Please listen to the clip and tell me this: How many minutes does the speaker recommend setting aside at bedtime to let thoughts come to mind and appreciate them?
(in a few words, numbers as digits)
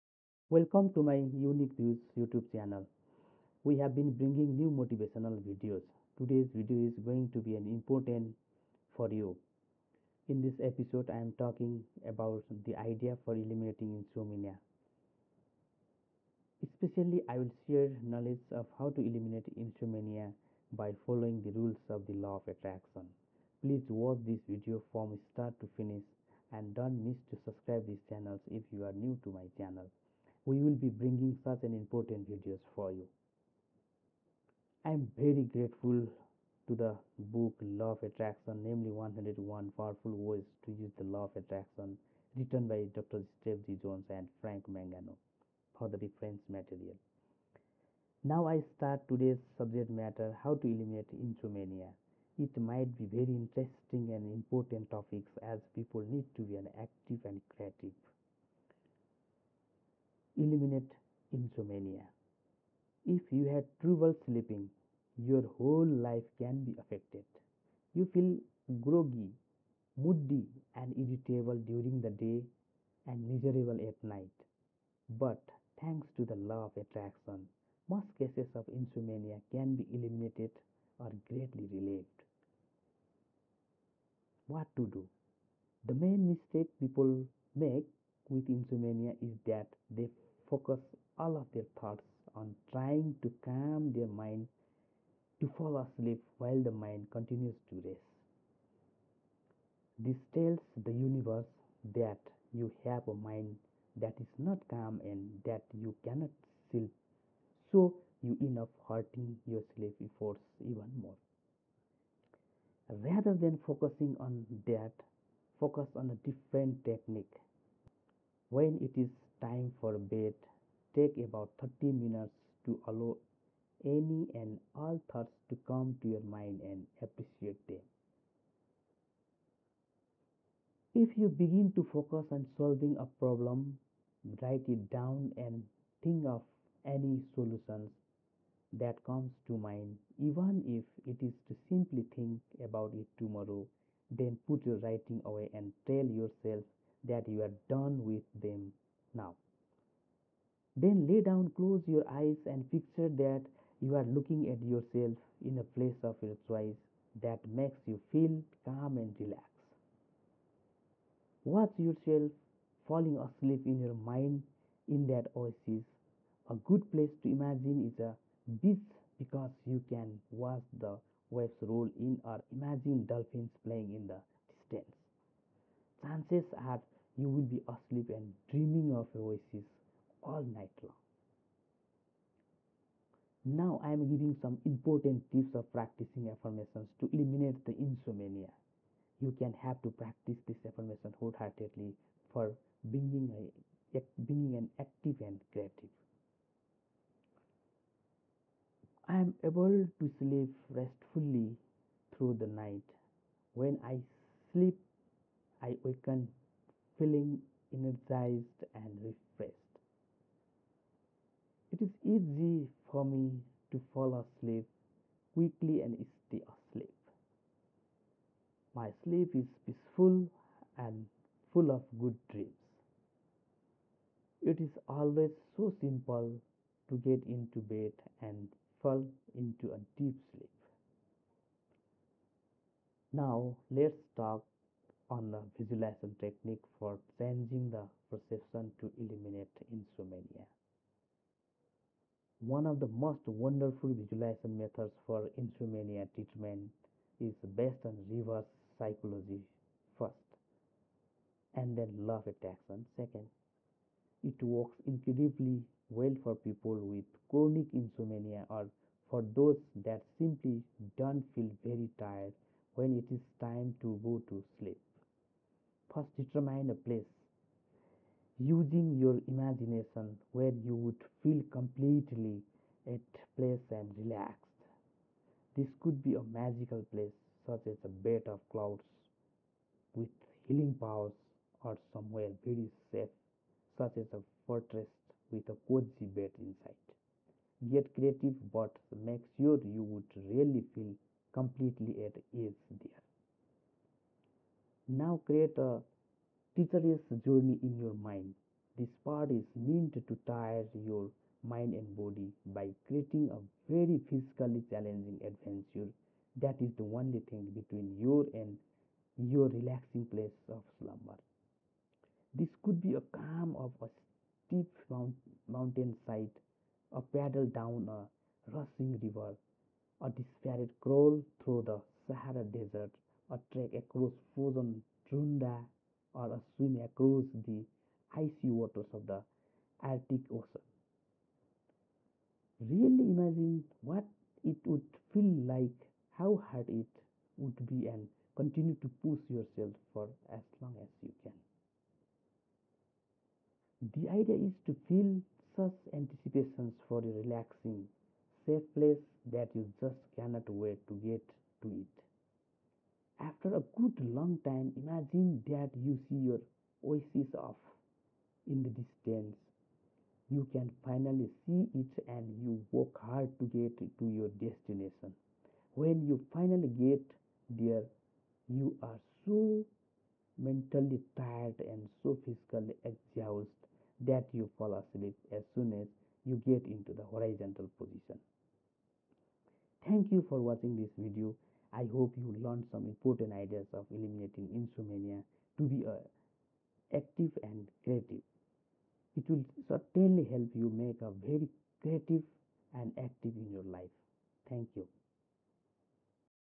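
30.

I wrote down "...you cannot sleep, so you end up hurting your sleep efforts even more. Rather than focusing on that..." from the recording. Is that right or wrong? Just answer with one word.
right.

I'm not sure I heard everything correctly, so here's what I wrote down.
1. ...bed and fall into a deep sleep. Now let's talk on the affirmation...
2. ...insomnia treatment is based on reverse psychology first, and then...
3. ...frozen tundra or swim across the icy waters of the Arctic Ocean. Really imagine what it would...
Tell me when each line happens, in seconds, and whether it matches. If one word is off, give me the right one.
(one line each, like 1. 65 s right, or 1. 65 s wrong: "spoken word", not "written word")
1. 227 s wrong: "visualization", not "affirmation"
2. 245 s right
3. 324 s right.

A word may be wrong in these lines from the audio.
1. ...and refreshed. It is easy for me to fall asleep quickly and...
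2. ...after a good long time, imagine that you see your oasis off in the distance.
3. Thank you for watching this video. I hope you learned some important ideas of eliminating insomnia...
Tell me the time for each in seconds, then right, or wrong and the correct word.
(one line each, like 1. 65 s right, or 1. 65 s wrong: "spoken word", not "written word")
1. 208 s right
2. 353 s right
3. 379 s right.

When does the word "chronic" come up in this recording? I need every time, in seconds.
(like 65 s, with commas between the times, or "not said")
257 s.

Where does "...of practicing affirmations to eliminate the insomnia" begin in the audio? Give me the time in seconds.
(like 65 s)
185 s.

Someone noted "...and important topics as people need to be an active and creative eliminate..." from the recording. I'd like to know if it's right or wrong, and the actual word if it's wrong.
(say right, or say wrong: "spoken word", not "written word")
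right.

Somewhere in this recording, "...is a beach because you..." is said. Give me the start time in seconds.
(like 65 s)
167 s.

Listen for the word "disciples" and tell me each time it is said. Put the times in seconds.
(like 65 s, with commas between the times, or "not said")
not said.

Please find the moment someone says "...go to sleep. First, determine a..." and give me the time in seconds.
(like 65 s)
264 s.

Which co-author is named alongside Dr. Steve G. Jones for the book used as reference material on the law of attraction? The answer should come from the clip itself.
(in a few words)
Frank Mangano.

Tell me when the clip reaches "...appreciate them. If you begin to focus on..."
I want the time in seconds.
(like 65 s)
127 s.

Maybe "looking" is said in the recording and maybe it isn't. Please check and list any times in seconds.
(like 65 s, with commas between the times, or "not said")
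154 s.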